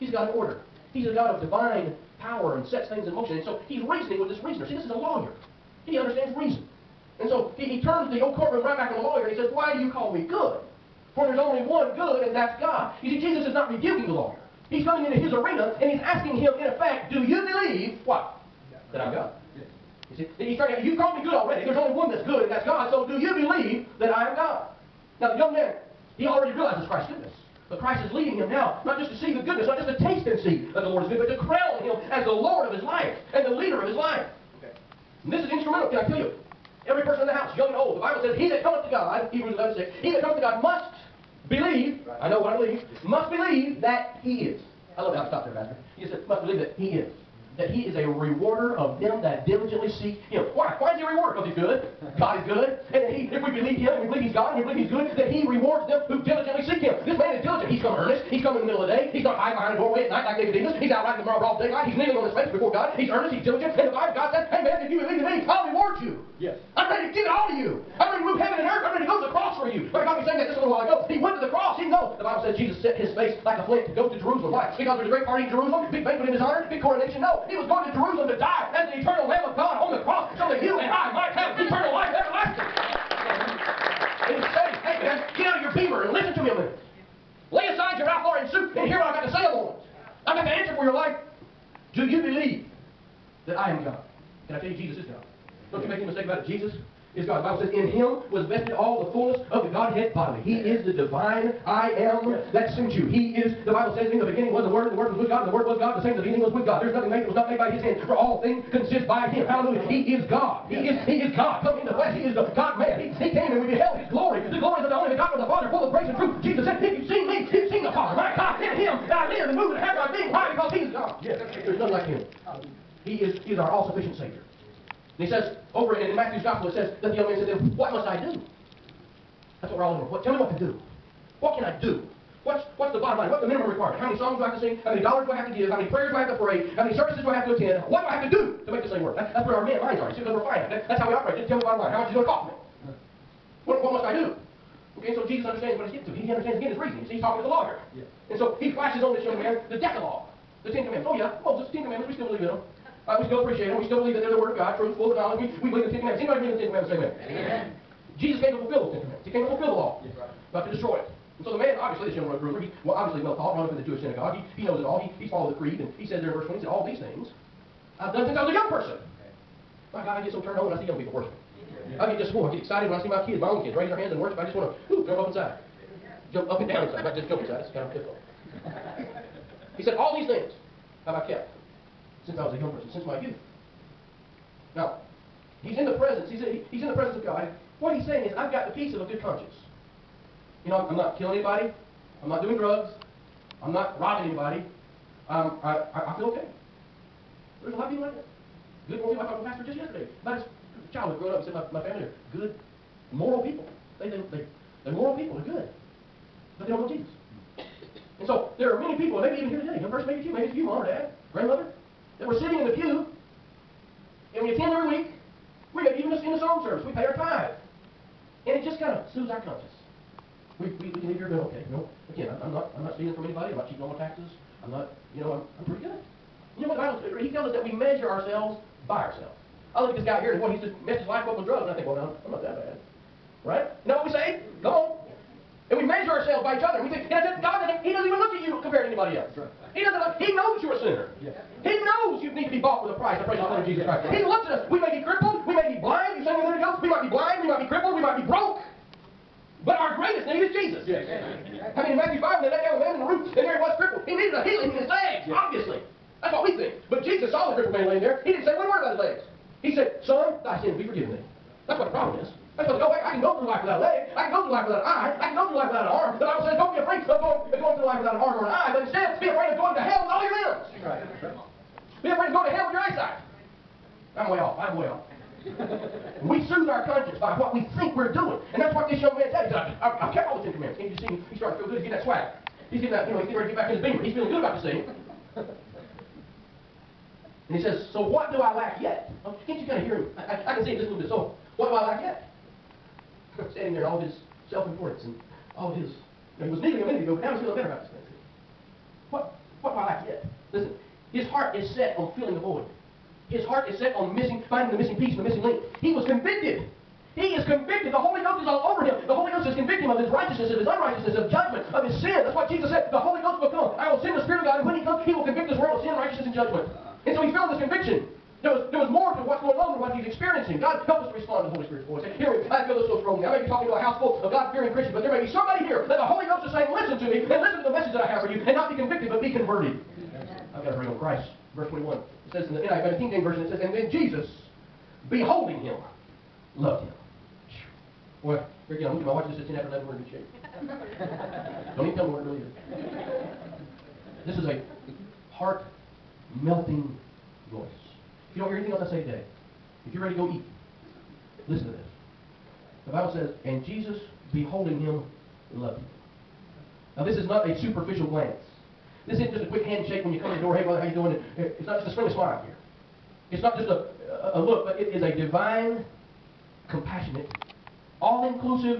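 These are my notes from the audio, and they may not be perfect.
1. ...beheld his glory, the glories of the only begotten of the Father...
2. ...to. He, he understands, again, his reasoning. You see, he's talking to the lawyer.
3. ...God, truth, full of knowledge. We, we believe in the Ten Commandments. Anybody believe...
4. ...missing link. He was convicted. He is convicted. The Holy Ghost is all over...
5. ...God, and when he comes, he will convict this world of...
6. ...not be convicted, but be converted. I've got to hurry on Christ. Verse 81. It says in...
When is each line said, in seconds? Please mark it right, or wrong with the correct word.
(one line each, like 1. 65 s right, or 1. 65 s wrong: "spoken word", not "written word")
1. 113 s right
2. 146 s right
3. 154 s right
4. 305 s right
5. 314 s right
6. 328 s wrong: "21", not "81".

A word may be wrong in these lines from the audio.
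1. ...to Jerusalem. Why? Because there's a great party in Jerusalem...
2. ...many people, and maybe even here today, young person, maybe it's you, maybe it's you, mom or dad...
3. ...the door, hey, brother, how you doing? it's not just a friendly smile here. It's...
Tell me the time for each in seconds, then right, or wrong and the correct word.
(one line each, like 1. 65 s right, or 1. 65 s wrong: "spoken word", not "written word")
1. 74 s right
2. 208 s right
3. 360 s right.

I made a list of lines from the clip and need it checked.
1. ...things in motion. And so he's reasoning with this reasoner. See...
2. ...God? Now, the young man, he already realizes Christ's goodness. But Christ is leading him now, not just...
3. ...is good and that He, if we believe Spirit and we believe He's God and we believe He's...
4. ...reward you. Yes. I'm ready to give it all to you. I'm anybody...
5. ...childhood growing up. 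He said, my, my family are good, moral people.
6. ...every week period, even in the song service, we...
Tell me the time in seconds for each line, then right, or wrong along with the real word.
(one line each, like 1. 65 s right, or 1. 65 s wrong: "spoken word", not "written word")
1. 2 s right
2. 24 s right
3. 52 s wrong: "Him", not "Spirit"
4. 65 s wrong: "ready", not "anybody"
5. 200 s right
6. 214 s right.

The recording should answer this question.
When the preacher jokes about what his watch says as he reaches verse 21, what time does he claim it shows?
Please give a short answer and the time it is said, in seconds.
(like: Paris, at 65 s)
11:10, at 339 s.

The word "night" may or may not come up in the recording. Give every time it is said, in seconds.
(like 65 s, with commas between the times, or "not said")
60 s.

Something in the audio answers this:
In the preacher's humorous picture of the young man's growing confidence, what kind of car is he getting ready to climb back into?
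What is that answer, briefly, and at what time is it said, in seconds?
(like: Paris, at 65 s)
Beamer, at 283 s.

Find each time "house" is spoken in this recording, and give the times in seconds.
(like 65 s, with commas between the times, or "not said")
37 s, 323 s.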